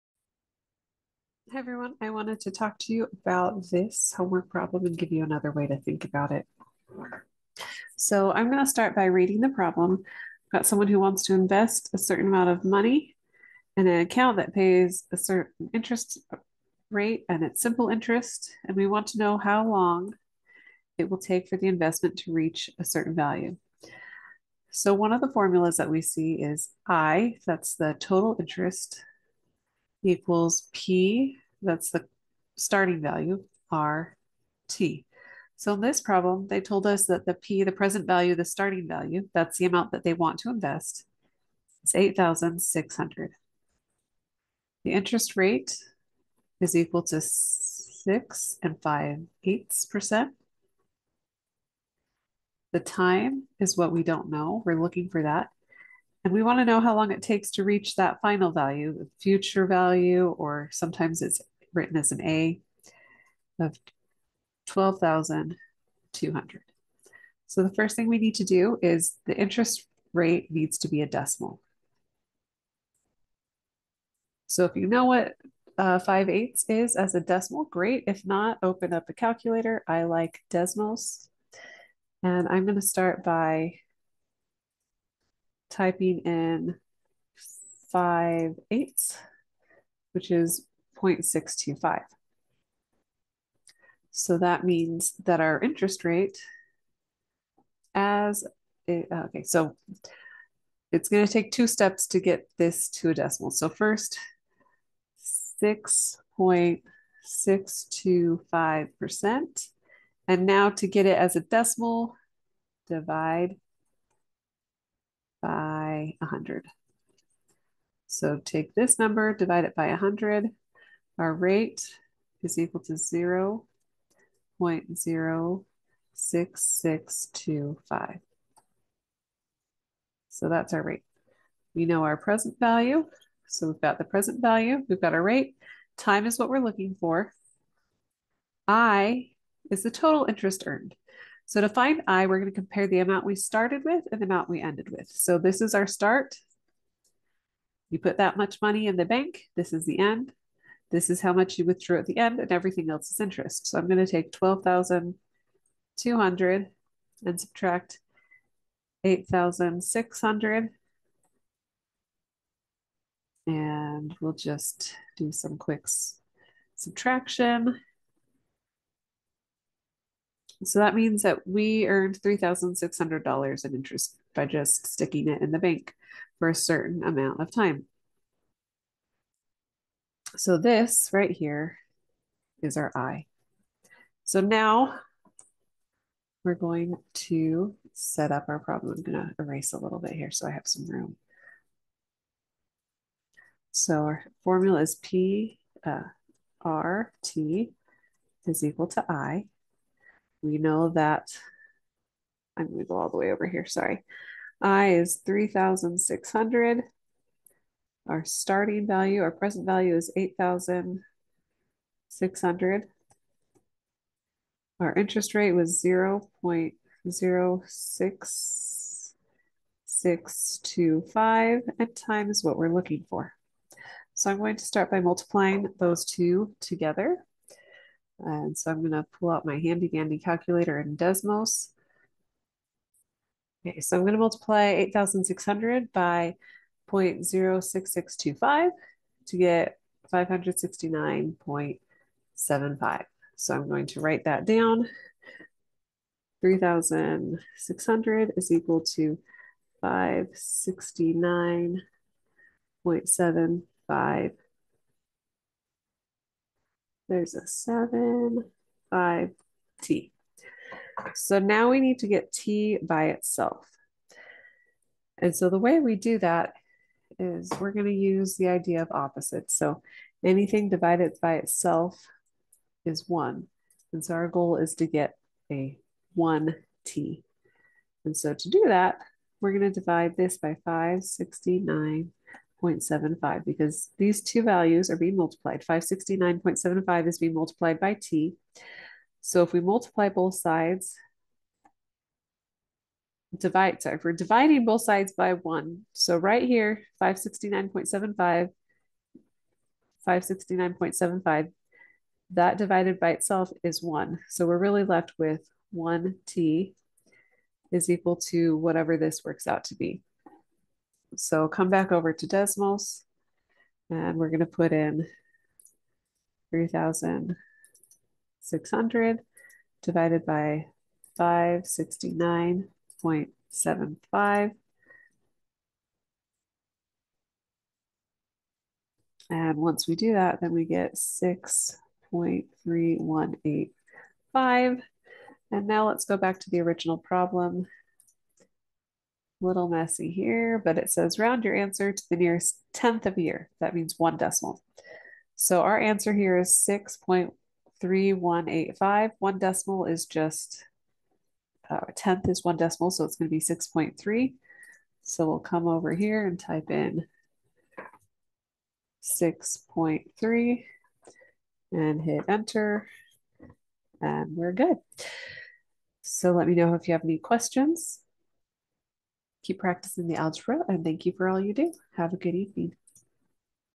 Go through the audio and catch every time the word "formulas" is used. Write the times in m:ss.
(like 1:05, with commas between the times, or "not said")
0:25, 3:14.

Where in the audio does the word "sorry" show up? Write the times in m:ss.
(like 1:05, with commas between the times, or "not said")
3:23, 4:53.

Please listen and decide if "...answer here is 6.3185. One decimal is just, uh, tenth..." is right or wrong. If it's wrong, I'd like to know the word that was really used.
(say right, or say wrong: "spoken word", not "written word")
right.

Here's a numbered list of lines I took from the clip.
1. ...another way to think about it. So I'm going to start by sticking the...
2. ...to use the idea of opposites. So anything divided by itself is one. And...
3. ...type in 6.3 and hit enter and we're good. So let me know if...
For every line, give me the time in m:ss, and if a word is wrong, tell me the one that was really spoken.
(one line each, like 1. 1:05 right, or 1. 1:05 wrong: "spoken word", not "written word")
1. 0:05 wrong: "reading", not "sticking"
2. 4:27 right
3. 5:56 right.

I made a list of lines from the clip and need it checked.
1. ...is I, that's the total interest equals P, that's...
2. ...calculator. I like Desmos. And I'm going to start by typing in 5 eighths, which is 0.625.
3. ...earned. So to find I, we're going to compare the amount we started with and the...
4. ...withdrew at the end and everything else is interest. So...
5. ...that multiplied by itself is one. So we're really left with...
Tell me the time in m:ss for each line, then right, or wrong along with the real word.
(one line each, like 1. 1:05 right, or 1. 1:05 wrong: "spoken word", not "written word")
1. 0:26 right
2. 1:19 right
3. 2:20 right
4. 2:31 right
5. 5:02 wrong: "divided", not "multiplied".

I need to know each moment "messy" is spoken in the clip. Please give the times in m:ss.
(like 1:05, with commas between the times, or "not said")
5:39.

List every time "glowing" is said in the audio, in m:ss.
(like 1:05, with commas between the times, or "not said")
not said.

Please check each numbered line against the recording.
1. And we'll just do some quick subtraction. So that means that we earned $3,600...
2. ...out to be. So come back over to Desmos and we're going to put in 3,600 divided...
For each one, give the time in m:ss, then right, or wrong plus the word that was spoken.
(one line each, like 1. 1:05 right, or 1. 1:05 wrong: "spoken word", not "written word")
1. 2:43 right
2. 5:09 right.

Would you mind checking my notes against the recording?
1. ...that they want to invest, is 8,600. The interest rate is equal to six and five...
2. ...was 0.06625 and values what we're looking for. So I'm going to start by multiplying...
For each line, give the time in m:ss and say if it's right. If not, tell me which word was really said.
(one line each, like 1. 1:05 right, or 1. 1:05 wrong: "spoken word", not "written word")
1. 0:39 right
2. 3:35 wrong: "times", not "values".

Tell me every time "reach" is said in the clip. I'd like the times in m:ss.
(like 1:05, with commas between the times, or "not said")
0:22, 0:57.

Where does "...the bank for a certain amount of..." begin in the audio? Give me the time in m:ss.
2:55.